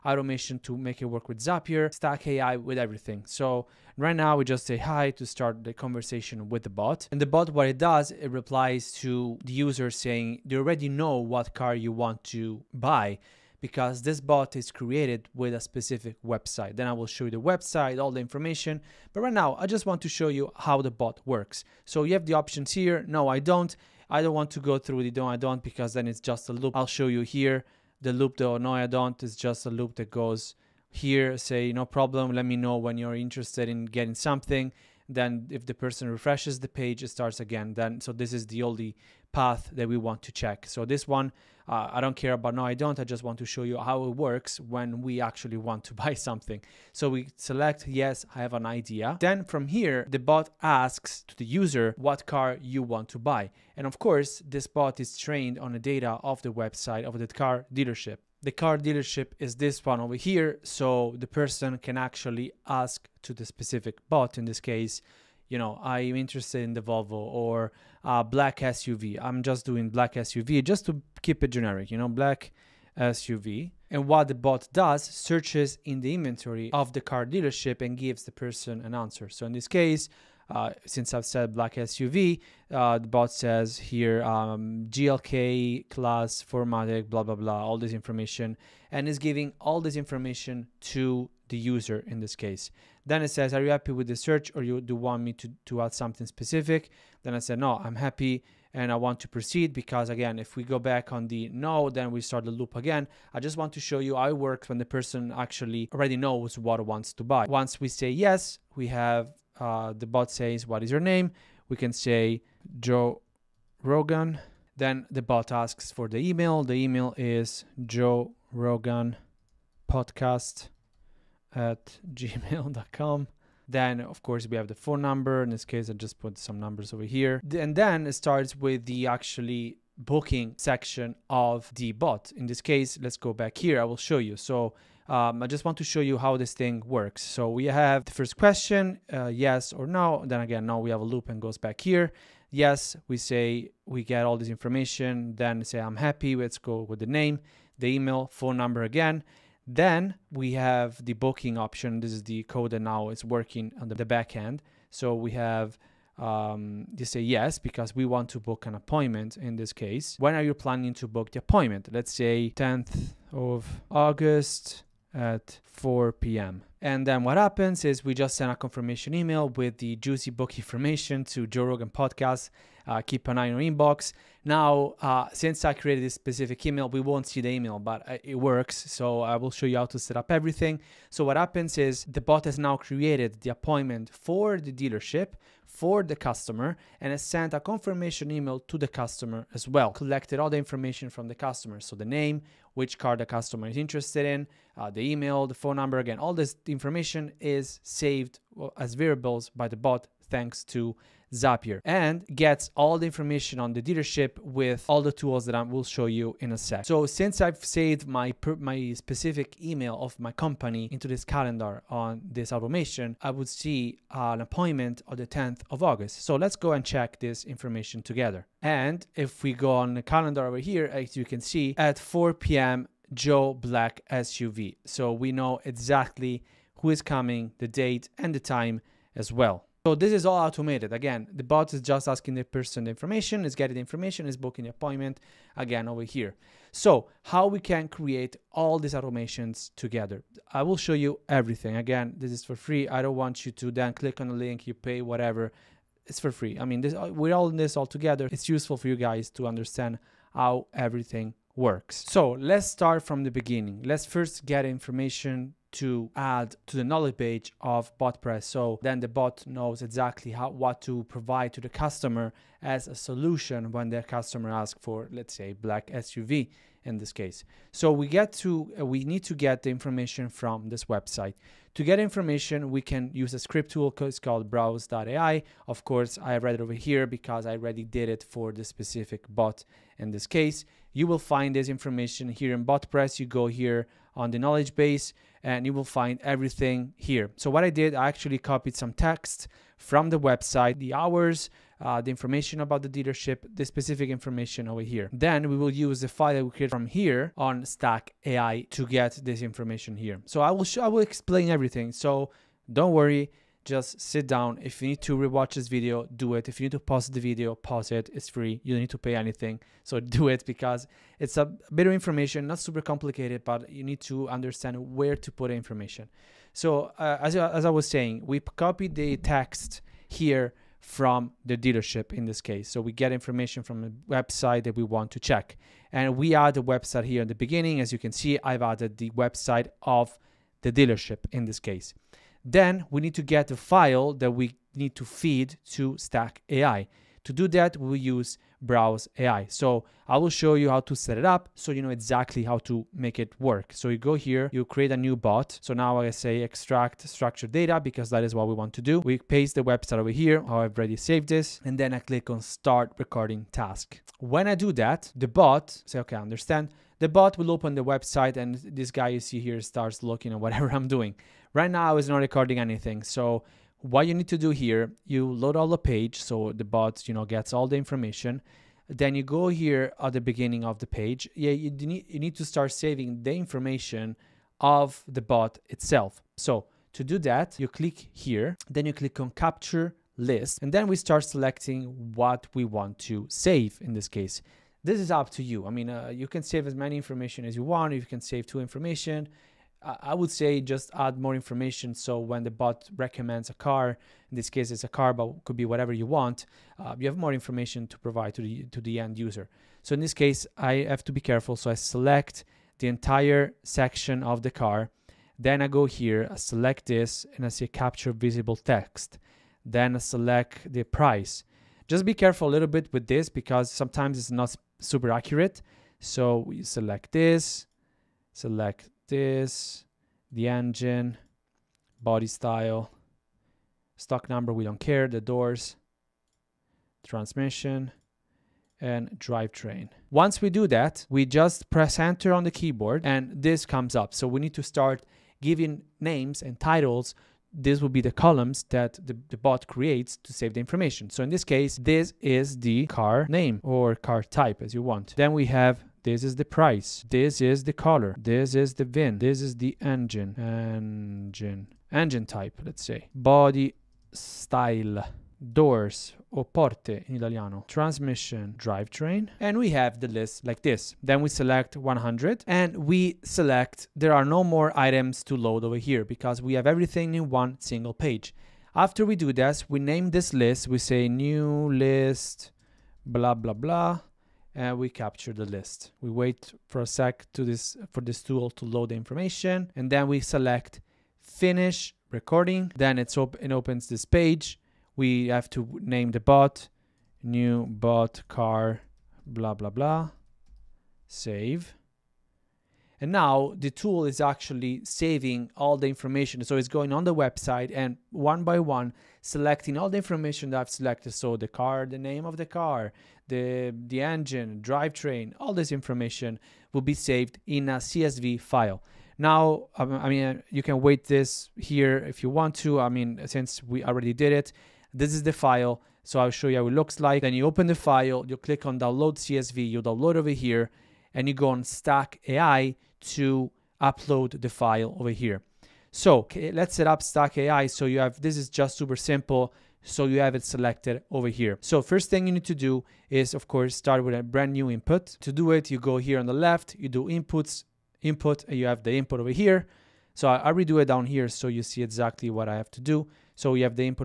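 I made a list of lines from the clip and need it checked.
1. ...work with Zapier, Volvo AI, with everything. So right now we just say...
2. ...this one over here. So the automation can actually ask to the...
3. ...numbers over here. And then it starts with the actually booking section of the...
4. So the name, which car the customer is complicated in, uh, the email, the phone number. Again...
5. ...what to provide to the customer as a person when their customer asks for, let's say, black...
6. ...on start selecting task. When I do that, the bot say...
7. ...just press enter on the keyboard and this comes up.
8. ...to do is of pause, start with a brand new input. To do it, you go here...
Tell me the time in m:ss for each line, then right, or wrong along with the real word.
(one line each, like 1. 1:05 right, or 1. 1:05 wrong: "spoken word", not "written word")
1. 0:01 wrong: "Stack", not "Volvo"
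2. 0:59 wrong: "person", not "automation"
3. 2:06 right
4. 3:11 wrong: "interested", not "complicated"
5. 4:20 wrong: "solution", not "person"
6. 5:52 wrong: "recording", not "selecting"
7. 7:11 right
8. 8:52 wrong: "course", not "pause".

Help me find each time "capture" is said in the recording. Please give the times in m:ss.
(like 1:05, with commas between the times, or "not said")
6:19, 6:47, 7:54.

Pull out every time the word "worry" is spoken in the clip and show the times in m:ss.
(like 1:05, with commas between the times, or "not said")
5:02.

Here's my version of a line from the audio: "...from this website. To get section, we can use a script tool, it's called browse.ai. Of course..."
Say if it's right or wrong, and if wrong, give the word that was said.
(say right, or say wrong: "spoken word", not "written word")
wrong: "information", not "section".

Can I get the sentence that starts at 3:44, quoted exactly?
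So we know exactly who is coming, the date, and the time as well.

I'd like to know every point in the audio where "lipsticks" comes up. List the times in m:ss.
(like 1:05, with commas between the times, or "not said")
not said.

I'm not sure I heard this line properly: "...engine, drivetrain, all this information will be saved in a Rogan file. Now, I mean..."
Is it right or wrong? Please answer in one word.
wrong.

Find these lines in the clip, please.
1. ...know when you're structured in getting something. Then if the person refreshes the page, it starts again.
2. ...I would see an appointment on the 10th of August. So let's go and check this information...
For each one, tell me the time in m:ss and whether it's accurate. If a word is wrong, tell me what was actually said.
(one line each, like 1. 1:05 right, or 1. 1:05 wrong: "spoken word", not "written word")
1. 0:32 wrong: "interested", not "structured"
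2. 3:33 right.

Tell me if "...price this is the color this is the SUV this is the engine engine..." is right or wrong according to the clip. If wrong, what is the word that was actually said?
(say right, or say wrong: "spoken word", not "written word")
wrong: "VIN", not "SUV".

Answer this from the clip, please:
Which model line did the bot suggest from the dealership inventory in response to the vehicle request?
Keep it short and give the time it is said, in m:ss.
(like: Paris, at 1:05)
GLK class, at 1:24.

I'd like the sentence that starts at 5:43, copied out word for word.
So you go here, you create a new bot.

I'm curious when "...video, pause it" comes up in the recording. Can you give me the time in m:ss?
5:07.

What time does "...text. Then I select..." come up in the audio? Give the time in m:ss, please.
6:48.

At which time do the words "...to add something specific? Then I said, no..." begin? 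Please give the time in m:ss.
1:35.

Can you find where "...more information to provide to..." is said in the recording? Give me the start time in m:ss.
6:37.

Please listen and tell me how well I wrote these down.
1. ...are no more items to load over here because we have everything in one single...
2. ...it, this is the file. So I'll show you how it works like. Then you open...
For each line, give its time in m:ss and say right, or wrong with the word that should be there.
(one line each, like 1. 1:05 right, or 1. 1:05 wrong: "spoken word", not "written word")
1. 7:44 right
2. 8:34 wrong: "looks", not "works".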